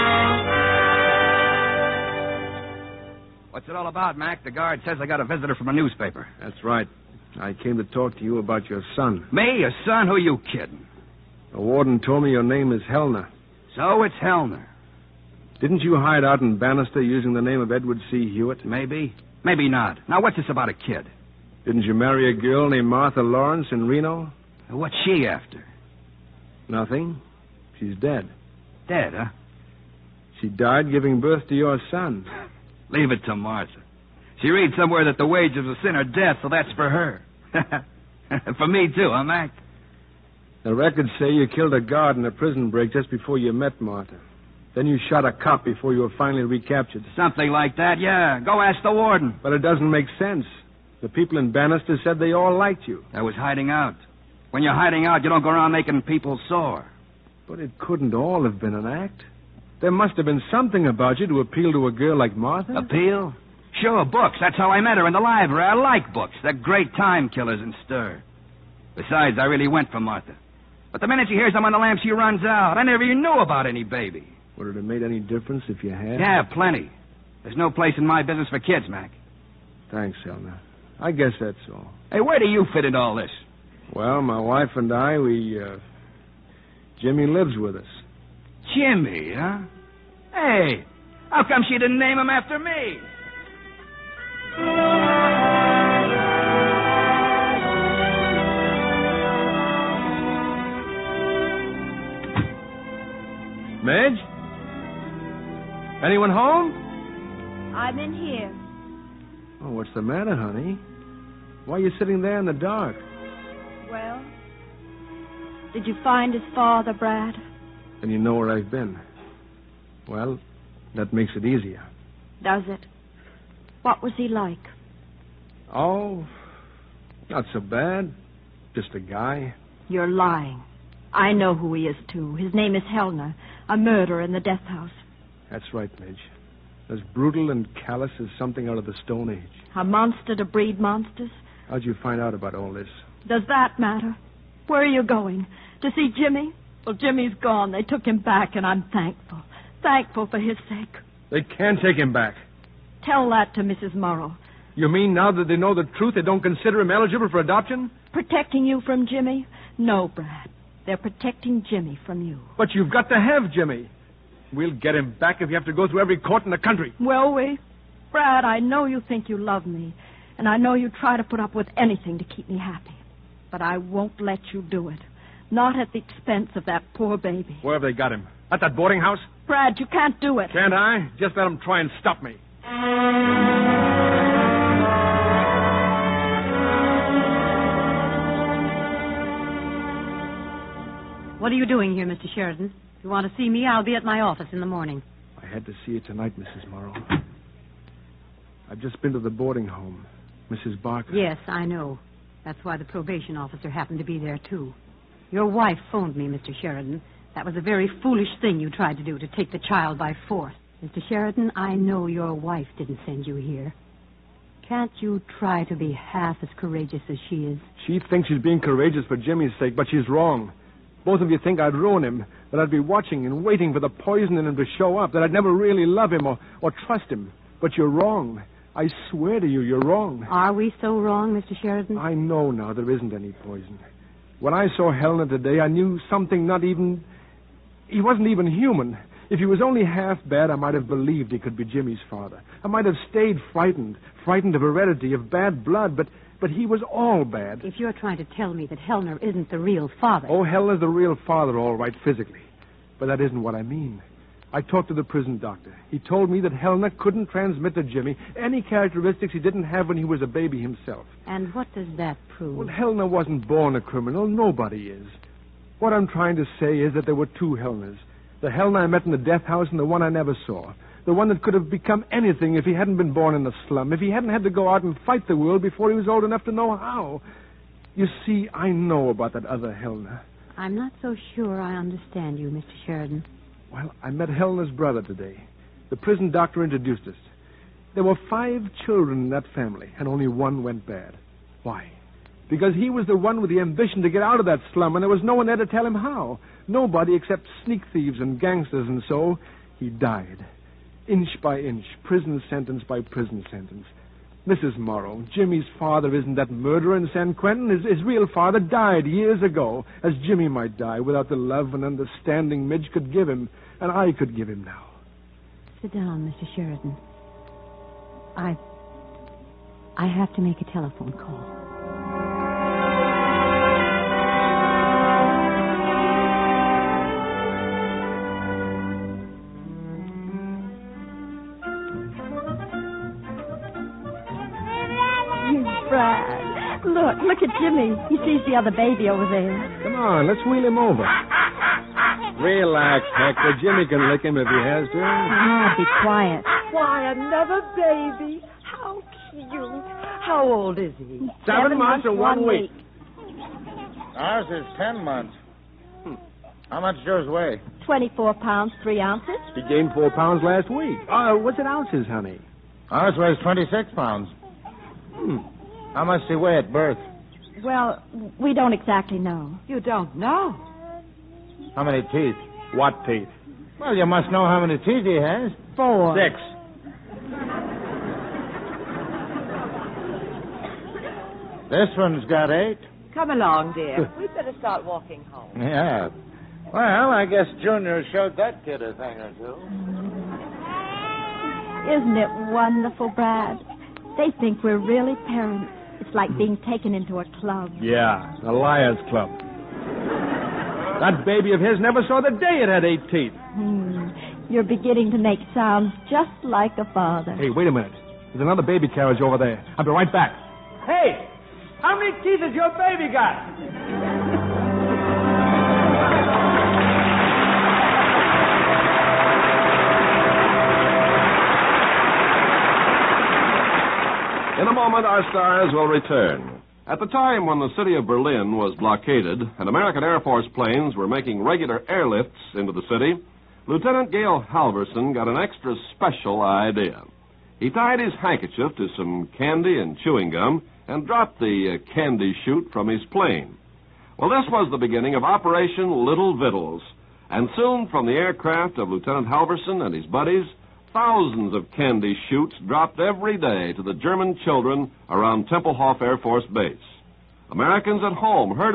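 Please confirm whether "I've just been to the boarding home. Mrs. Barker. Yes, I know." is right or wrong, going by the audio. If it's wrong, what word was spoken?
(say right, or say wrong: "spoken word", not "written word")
right.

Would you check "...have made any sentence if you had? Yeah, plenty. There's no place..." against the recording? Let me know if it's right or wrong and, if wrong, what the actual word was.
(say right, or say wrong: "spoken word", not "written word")
wrong: "difference", not "sentence".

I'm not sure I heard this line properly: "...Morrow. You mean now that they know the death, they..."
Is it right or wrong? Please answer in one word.
wrong.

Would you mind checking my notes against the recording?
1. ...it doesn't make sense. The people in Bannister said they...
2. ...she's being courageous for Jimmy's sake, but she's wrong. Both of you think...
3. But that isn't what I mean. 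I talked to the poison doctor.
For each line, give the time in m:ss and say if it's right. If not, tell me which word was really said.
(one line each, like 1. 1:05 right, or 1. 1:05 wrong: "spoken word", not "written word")
1. 0:49 right
2. 3:38 right
3. 4:12 wrong: "prison", not "poison".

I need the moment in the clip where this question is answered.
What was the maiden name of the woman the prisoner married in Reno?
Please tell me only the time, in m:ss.
0:22.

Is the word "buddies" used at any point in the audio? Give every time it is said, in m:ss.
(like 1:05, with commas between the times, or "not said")
7:30.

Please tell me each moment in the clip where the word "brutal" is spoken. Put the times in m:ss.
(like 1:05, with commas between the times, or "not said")
2:17.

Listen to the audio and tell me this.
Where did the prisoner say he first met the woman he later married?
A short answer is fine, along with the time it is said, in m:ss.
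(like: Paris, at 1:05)
The library, at 1:05.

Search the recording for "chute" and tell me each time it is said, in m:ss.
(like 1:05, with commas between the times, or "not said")
7:22, 7:32.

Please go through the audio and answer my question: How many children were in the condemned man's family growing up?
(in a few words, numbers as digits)
5.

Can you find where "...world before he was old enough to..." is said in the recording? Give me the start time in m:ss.
4:35.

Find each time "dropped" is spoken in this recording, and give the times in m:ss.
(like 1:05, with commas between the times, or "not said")
7:21, 7:32.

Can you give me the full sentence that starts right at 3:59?
If he was only half bad, I might have believed he could be Jimmy's father.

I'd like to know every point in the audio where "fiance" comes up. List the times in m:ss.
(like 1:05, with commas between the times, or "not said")
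not said.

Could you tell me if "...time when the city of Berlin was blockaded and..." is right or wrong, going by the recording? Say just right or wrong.
right.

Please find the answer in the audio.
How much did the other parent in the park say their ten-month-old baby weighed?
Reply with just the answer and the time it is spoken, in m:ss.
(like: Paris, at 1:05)
26 pounds, at 6:03.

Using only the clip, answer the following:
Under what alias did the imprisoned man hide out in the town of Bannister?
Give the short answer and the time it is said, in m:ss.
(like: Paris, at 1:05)
Edward C. Hewitt, at 0:17.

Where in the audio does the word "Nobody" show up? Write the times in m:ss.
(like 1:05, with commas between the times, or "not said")
4:24, 4:56.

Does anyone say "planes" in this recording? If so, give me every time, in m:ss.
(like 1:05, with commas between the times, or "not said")
7:10, 7:23.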